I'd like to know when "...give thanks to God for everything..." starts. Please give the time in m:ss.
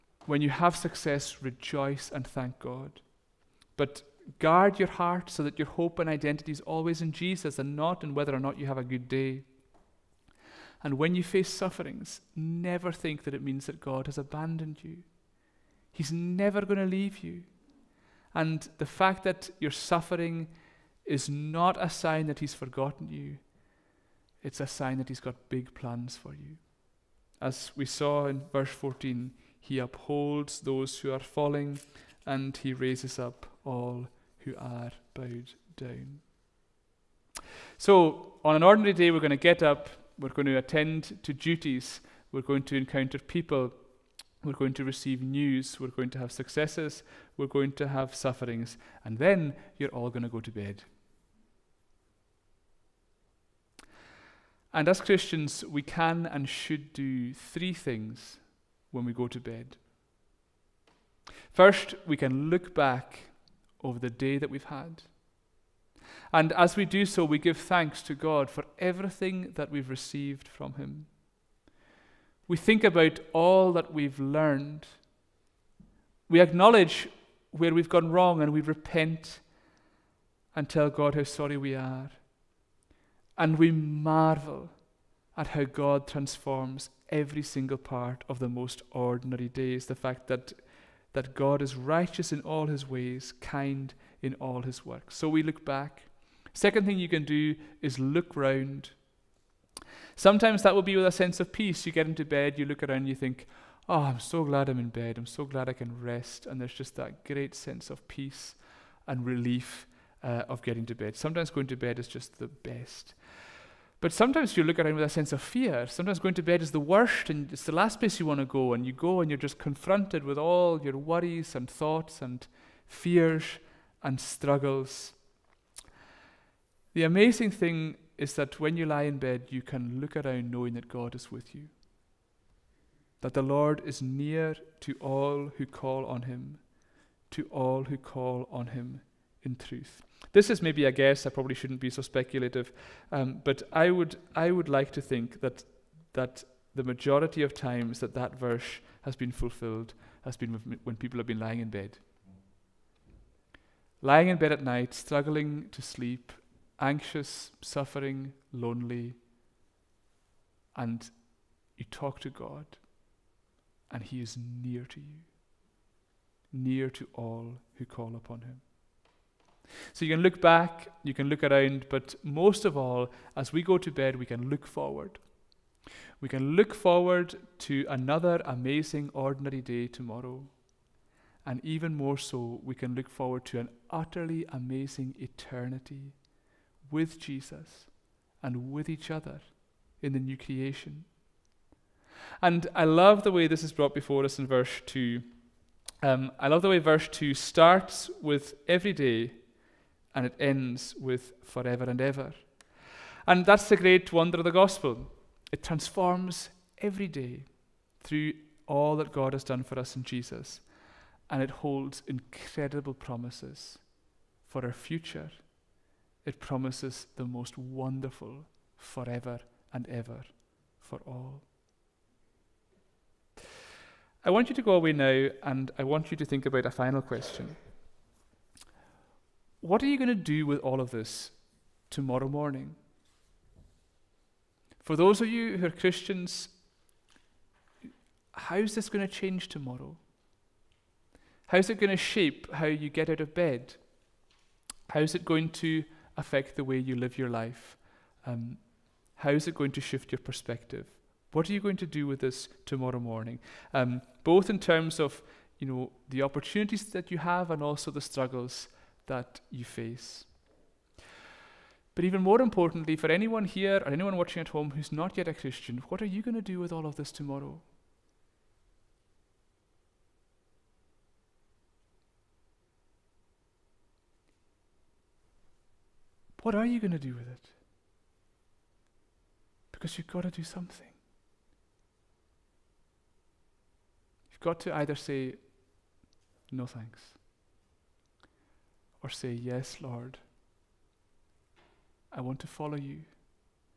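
1:07.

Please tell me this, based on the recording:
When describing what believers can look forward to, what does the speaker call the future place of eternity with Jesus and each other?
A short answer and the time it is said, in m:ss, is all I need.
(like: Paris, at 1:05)
the new creation, at 3:10.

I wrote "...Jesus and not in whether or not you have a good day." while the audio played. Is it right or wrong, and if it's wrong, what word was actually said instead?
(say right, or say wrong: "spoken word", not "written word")
right.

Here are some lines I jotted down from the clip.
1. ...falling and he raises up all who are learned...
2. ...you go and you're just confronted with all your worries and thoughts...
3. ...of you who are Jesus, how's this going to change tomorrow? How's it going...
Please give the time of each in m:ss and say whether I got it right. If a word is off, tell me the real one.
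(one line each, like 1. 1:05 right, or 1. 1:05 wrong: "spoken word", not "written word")
1. 0:31 wrong: "bowed", not "learned"
2. 1:58 right
3. 3:55 wrong: "Christians", not "Jesus".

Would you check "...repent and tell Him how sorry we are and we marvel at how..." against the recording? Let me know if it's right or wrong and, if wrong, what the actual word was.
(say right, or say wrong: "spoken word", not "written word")
wrong: "God", not "Him".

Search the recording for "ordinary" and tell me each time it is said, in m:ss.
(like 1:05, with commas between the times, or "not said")
0:38, 1:28, 2:59.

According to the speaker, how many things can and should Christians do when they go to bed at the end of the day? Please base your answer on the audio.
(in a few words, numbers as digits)
3.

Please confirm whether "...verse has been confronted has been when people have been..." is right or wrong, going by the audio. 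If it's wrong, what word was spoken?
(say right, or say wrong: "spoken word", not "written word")
wrong: "fulfilled", not "confronted".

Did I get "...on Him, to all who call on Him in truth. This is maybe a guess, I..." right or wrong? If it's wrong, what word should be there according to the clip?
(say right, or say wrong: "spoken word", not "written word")
right.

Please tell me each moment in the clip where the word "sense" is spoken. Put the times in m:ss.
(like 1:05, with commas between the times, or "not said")
1:41, 1:47, 1:55.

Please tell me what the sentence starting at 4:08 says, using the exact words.
Um, how is it going to shift your perspective?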